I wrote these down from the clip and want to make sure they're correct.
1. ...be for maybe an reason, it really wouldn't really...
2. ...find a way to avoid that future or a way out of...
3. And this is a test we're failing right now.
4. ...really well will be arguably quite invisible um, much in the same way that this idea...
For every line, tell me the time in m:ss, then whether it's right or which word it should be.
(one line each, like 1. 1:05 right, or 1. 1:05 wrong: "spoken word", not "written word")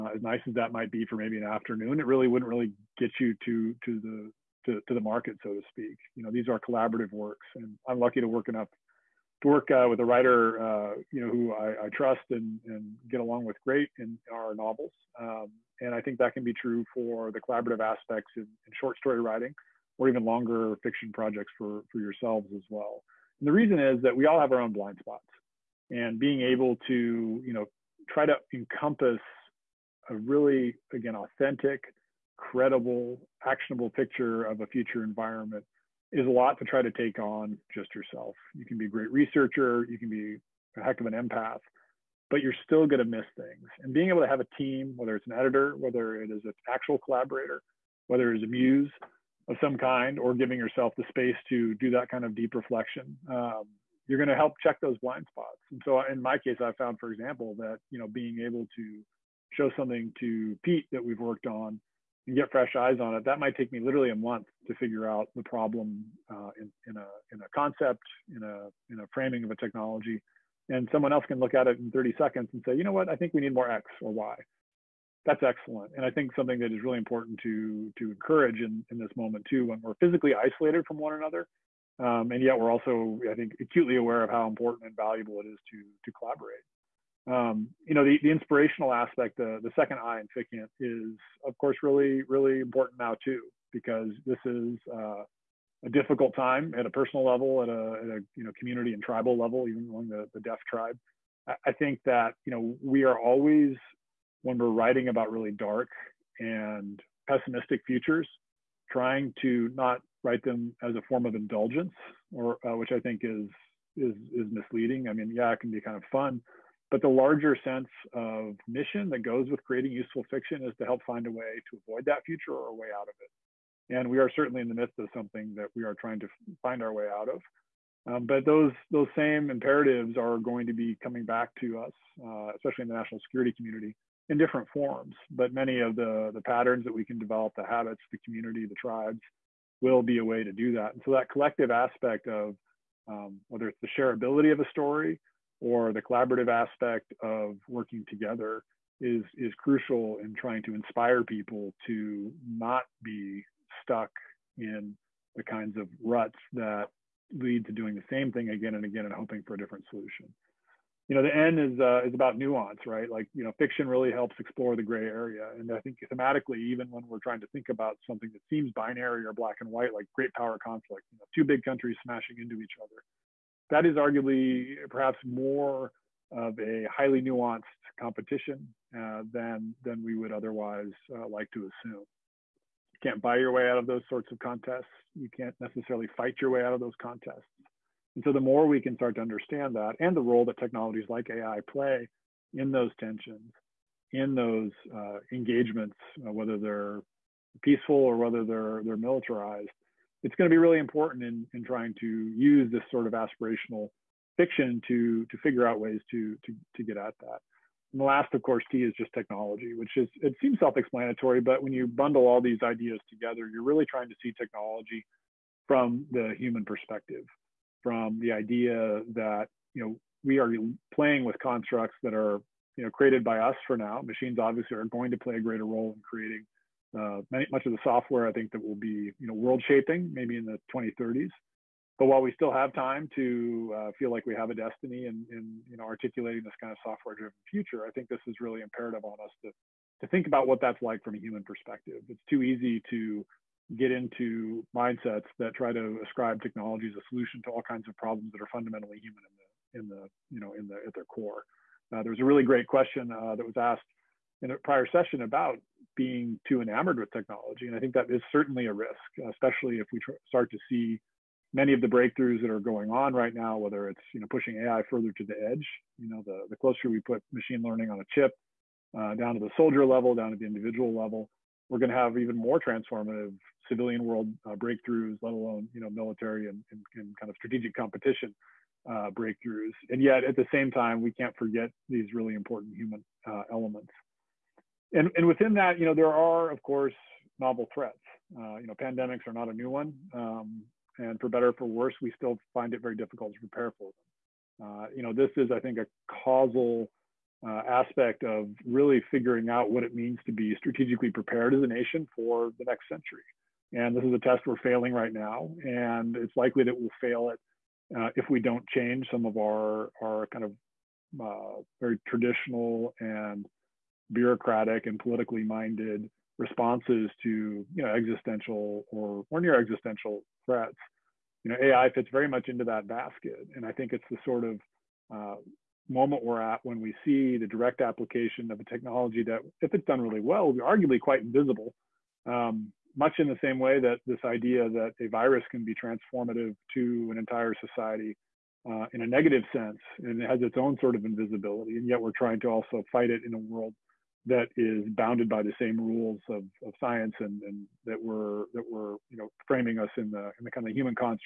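1. 0:00 wrong: "afternoon", not "reason"
2. 2:01 right
3. 5:03 right
4. 5:30 right.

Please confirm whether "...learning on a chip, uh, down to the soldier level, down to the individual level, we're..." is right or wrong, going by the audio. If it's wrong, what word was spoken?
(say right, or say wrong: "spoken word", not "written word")
right.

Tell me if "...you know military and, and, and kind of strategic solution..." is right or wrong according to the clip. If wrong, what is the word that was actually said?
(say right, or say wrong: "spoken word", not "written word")
wrong: "competition", not "solution".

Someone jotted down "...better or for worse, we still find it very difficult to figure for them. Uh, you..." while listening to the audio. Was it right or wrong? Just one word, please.
wrong.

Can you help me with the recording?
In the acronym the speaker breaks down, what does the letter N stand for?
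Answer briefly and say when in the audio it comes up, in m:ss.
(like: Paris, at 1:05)
nuance, at 2:42.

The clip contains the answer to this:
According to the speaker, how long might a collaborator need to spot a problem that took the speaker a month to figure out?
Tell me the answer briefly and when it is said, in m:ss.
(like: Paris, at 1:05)
30 seconds, at 1:11.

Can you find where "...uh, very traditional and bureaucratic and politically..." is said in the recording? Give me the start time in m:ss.
5:11.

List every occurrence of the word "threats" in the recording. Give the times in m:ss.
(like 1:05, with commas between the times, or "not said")
4:47, 5:20.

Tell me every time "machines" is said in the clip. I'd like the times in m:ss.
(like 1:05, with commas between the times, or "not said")
3:44, 4:27.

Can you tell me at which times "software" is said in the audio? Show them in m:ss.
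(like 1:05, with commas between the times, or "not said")
3:47, 3:56.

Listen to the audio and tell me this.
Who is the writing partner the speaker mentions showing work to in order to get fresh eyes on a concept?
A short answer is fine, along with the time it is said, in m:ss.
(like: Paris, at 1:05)
Pete, at 1:00.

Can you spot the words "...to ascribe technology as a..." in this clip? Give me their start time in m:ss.
4:05.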